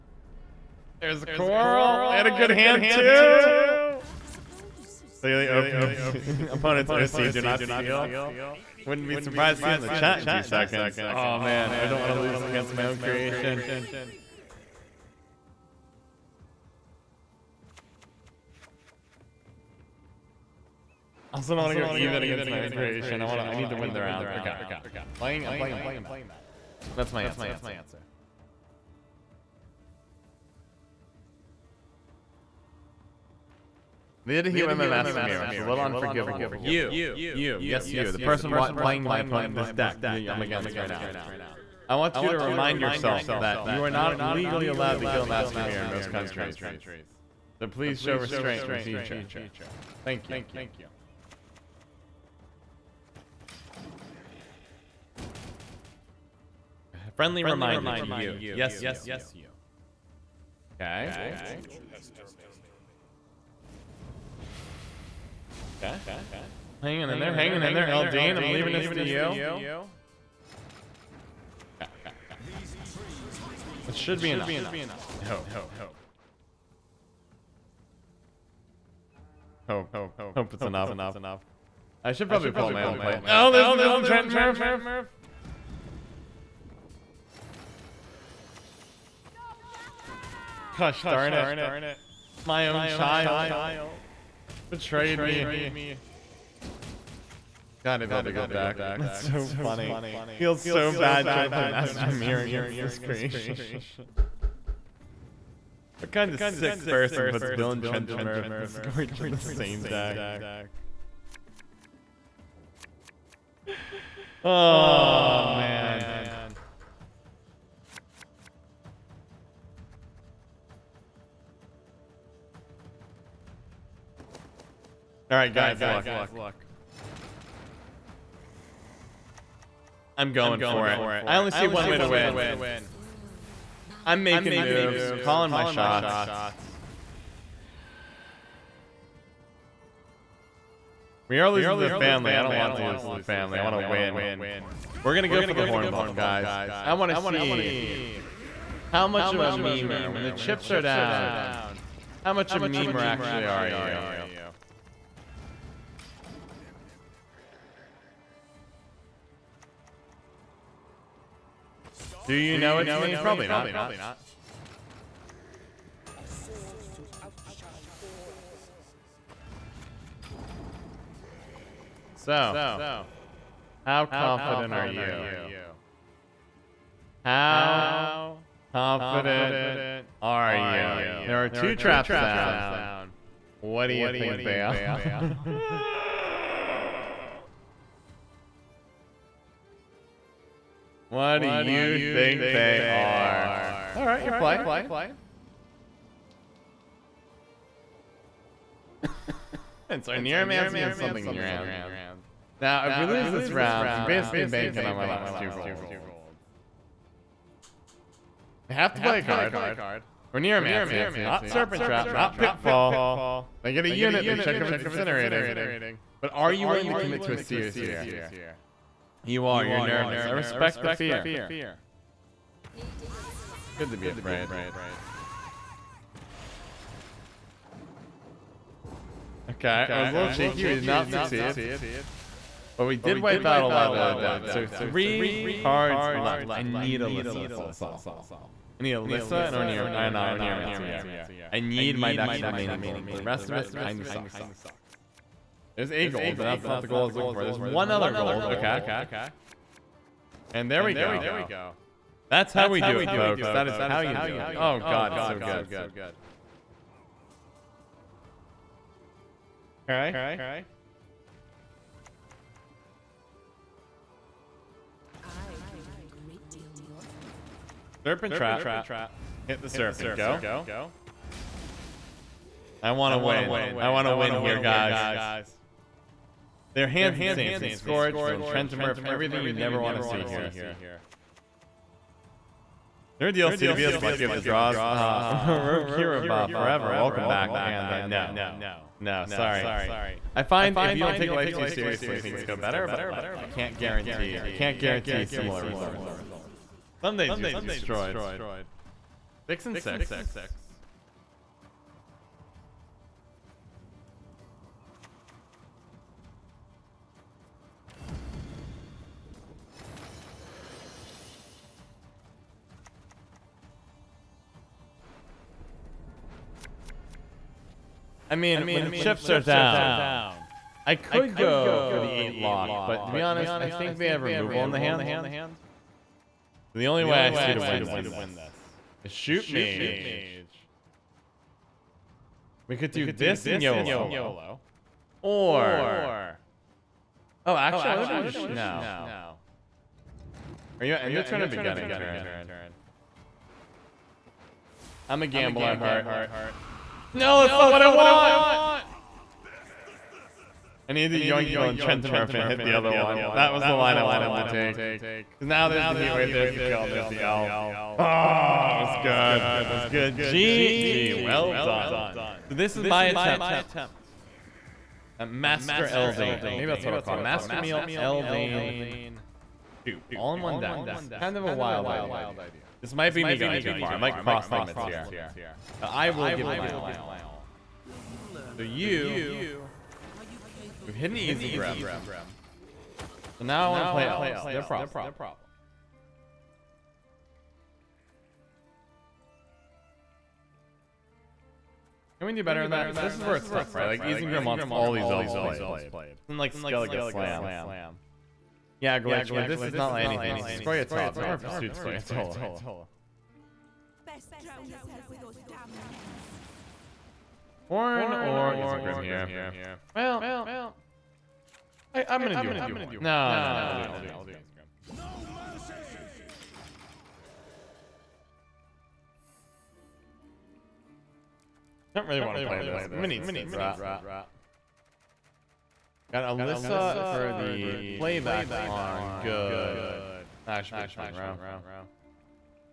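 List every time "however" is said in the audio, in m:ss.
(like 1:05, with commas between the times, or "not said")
not said.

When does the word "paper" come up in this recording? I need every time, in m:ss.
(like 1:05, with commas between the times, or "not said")
not said.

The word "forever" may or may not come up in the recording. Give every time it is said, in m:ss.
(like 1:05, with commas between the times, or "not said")
4:46.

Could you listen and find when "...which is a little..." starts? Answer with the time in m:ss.
0:35.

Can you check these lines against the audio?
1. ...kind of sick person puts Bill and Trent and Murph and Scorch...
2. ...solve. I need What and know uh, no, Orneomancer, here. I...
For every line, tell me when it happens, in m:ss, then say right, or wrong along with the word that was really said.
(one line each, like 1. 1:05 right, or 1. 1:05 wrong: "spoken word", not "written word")
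1. 1:46 right
2. 3:57 wrong: "Alyssa", not "What".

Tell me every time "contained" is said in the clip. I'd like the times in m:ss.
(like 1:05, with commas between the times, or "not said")
not said.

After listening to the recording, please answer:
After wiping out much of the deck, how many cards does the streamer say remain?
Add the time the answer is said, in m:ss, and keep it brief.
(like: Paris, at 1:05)
3, at 3:54.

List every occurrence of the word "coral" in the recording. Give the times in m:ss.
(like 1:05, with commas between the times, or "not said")
0:01.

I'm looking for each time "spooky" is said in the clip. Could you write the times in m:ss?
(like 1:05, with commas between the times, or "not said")
not said.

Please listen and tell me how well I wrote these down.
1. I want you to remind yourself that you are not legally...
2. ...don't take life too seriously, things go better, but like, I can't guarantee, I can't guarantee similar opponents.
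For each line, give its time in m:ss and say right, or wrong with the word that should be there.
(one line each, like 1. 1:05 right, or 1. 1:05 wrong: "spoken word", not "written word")
1. 0:41 right
2. 4:51 wrong: "results", not "opponents".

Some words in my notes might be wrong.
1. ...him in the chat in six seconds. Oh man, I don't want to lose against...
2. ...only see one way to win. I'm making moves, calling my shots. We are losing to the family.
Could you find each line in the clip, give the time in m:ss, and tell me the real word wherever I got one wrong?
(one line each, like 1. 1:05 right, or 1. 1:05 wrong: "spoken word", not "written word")
1. 0:09 wrong: "two", not "six"
2. 2:11 right.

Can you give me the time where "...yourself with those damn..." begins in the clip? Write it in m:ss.
6:44.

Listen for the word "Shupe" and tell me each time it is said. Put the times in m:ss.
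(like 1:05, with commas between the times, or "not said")
5:29, 6:09.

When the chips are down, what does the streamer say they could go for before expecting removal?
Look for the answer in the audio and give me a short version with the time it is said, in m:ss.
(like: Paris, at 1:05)
8 lock, at 5:20.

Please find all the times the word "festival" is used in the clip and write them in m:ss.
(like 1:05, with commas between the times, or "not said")
not said.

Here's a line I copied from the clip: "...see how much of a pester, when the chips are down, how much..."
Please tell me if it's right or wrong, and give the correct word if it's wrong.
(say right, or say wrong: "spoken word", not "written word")
wrong: "memer", not "pester".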